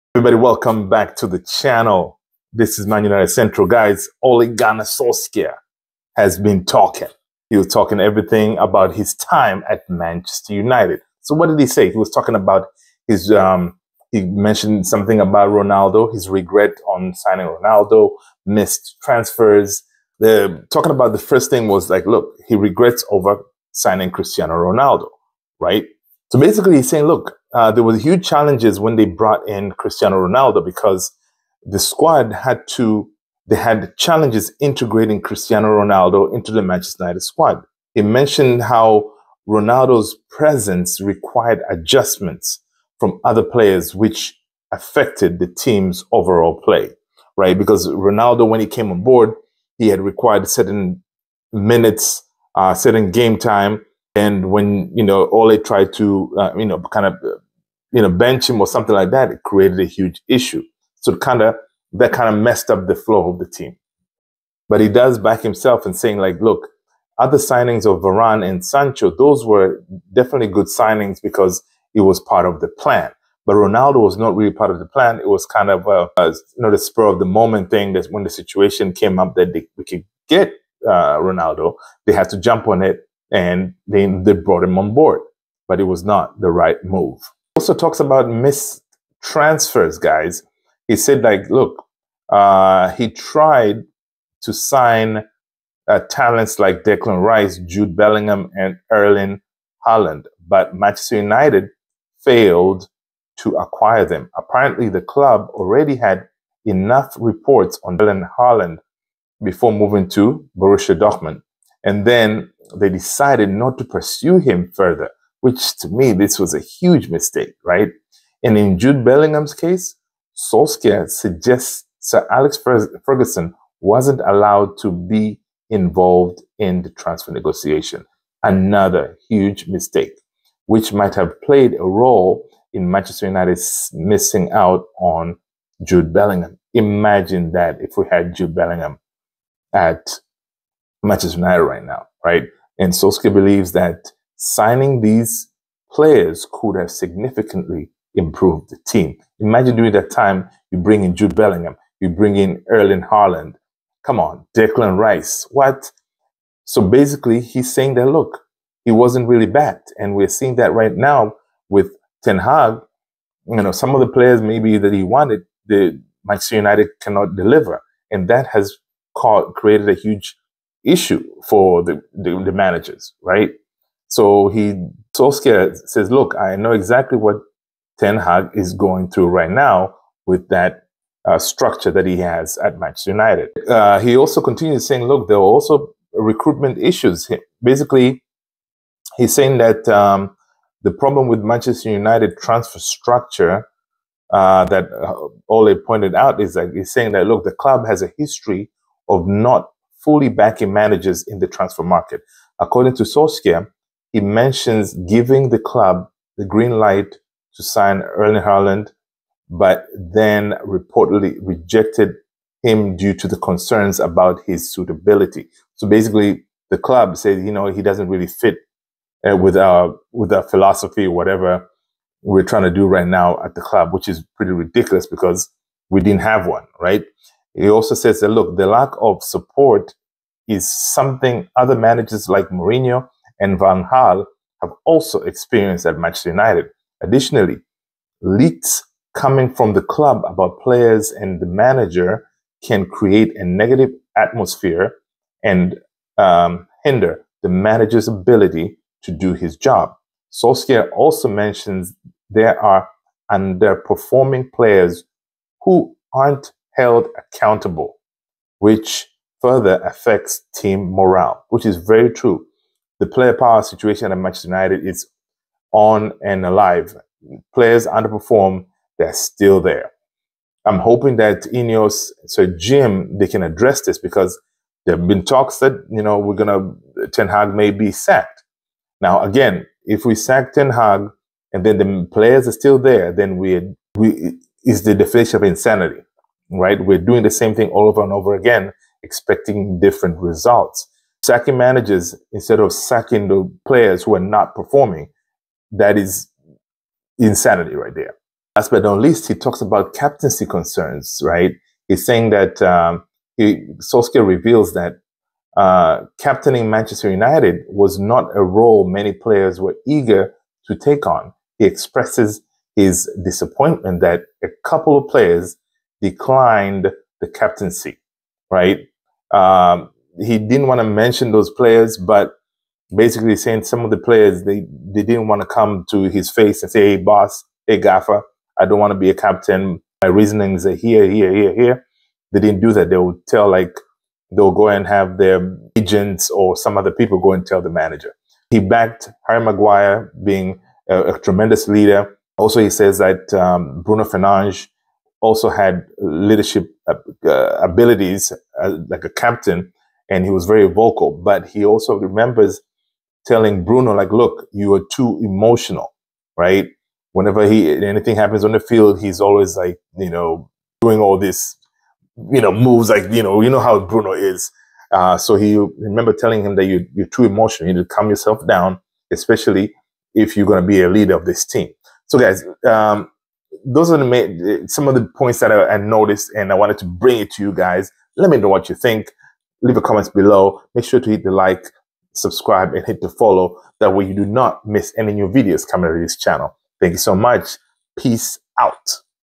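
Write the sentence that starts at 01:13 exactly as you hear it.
But Ronaldo was not really part of the plan.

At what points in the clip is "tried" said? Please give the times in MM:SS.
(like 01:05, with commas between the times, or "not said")
00:55, 01:33.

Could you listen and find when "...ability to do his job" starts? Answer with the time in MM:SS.
04:08.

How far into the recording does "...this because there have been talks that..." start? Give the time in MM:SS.
04:33.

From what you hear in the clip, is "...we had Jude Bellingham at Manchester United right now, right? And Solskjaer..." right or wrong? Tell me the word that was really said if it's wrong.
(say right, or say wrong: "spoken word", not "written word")
right.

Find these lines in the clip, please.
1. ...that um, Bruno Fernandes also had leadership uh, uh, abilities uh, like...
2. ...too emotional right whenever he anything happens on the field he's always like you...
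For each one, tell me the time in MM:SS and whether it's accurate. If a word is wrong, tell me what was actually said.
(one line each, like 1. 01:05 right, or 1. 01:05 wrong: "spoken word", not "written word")
1. 05:42 right
2. 05:54 right.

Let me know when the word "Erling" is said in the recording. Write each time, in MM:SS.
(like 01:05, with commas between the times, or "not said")
01:38, 01:48, 02:32, 03:28.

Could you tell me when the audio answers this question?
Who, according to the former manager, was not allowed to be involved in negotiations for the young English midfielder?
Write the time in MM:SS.
02:01.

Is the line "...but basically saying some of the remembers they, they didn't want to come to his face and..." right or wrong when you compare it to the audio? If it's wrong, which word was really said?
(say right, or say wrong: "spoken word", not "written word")
wrong: "players", not "remembers".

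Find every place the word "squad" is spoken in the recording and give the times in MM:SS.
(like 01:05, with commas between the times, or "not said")
00:31, 00:37.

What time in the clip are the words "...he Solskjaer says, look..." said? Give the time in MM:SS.
02:54.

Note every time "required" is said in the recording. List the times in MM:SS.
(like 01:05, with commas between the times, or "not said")
00:41, 00:49.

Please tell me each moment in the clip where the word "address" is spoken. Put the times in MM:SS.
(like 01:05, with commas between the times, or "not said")
04:33.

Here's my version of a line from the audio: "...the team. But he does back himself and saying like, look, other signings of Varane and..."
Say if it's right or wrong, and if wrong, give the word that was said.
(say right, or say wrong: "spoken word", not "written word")
right.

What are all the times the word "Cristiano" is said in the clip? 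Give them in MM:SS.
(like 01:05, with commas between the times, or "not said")
00:24, 00:29, 00:35.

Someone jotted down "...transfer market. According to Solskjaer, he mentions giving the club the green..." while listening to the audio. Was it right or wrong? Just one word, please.
right.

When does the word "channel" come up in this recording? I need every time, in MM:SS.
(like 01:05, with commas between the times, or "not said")
00:01, 06:26.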